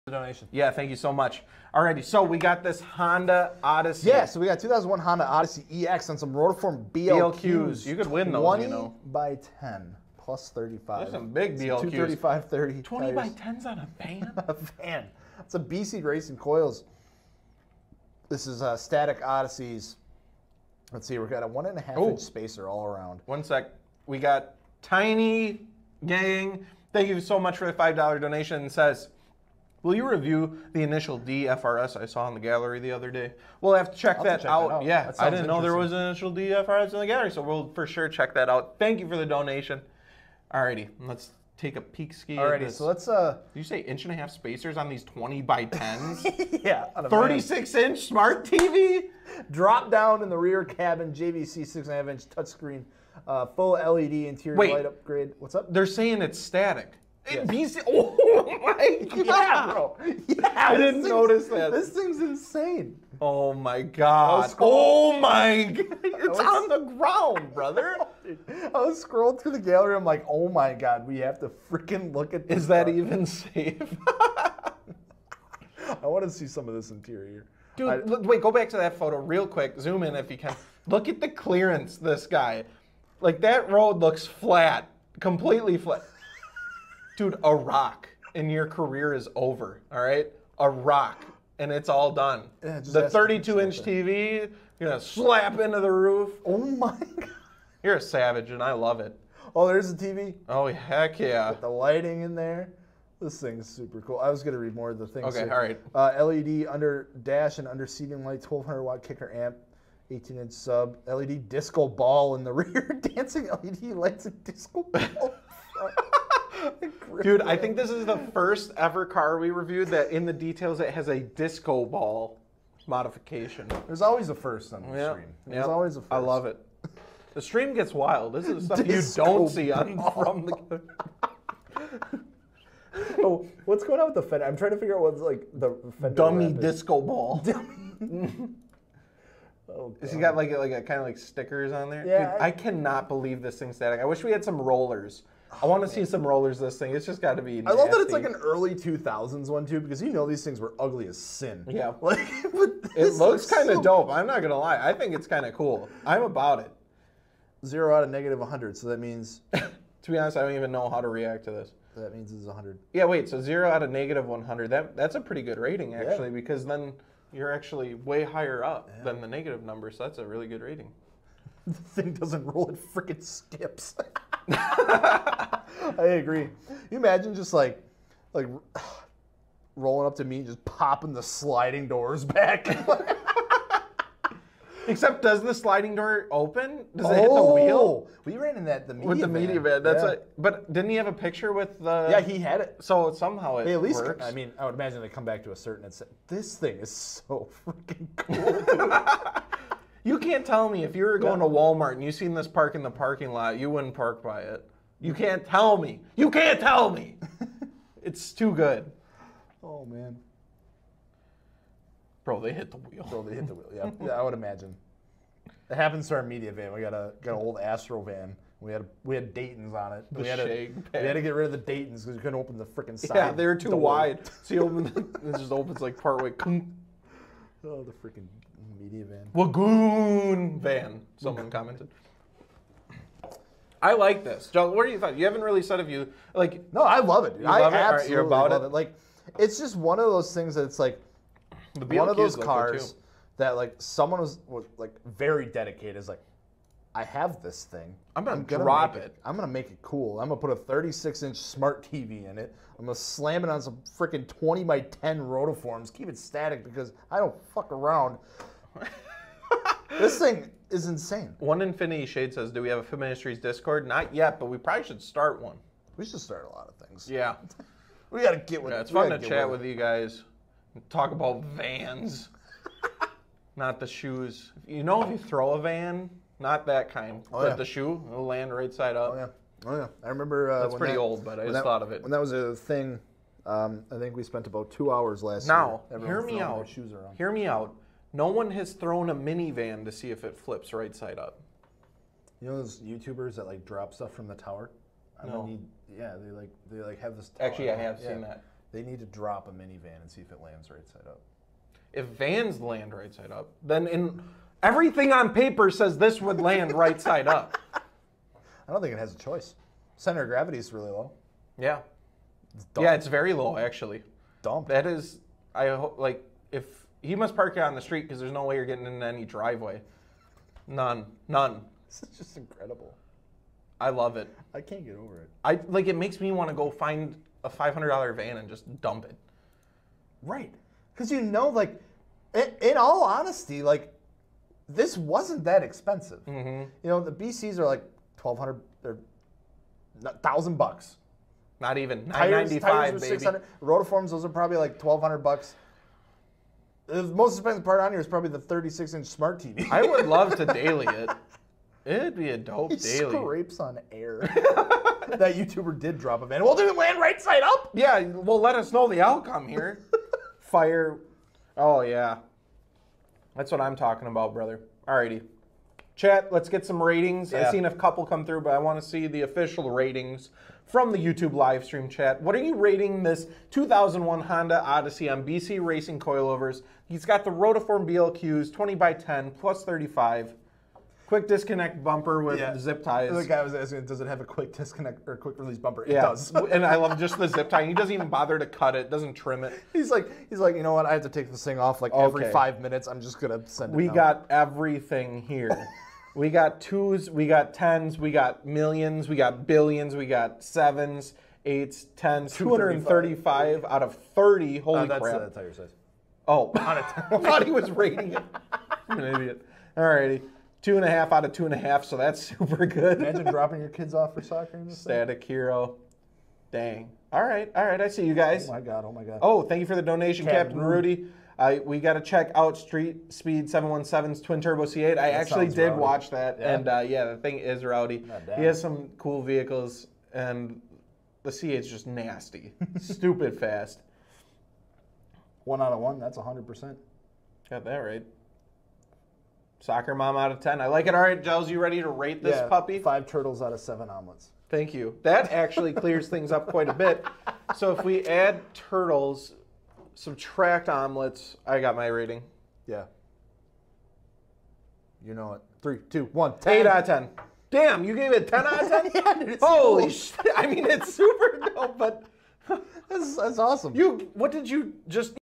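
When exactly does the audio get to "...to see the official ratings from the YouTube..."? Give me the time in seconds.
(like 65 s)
368 s.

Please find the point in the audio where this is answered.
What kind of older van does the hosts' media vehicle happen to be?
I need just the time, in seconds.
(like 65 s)
217 s.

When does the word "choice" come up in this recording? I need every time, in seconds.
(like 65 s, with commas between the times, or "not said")
309 s.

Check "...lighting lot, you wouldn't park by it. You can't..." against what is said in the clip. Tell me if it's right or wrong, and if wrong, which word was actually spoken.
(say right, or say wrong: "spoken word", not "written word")
wrong: "parking", not "lighting".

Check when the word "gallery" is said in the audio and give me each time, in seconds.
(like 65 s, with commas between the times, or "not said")
32 s, 37 s, 69 s.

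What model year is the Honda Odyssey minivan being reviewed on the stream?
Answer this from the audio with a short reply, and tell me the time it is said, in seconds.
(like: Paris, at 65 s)
2001, at 4 s.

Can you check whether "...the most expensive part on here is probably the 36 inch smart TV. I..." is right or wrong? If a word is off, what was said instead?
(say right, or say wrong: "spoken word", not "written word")
right.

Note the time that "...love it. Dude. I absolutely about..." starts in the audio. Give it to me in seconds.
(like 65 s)
236 s.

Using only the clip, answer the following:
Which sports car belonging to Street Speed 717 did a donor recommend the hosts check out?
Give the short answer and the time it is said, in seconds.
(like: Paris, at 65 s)
twin turbo C8, at 424 s.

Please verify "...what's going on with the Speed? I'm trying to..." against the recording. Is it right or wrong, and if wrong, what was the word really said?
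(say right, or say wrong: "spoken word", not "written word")
wrong: "Fender", not "Speed".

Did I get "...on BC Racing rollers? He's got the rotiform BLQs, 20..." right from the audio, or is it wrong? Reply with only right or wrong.
wrong.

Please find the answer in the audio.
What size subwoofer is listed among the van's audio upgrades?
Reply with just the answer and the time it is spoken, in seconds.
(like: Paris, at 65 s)
18 inch, at 110 s.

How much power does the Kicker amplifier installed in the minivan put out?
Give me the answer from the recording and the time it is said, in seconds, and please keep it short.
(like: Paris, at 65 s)
1200 watt, at 108 s.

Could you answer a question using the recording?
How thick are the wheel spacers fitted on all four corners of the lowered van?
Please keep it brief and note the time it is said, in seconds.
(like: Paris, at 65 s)
1.5 inch, at 21 s.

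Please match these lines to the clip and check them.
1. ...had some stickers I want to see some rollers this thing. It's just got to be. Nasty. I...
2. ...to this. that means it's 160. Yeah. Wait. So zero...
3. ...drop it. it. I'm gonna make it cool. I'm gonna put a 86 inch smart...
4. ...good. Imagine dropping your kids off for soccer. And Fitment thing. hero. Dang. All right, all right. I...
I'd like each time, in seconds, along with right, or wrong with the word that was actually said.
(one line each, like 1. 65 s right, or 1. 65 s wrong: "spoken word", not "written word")
1. 144 s wrong: "rollers", not "stickers"
2. 161 s wrong: "100", not "160"
3. 248 s wrong: "36", not "86"
4. 412 s wrong: "Static", not "Fitment".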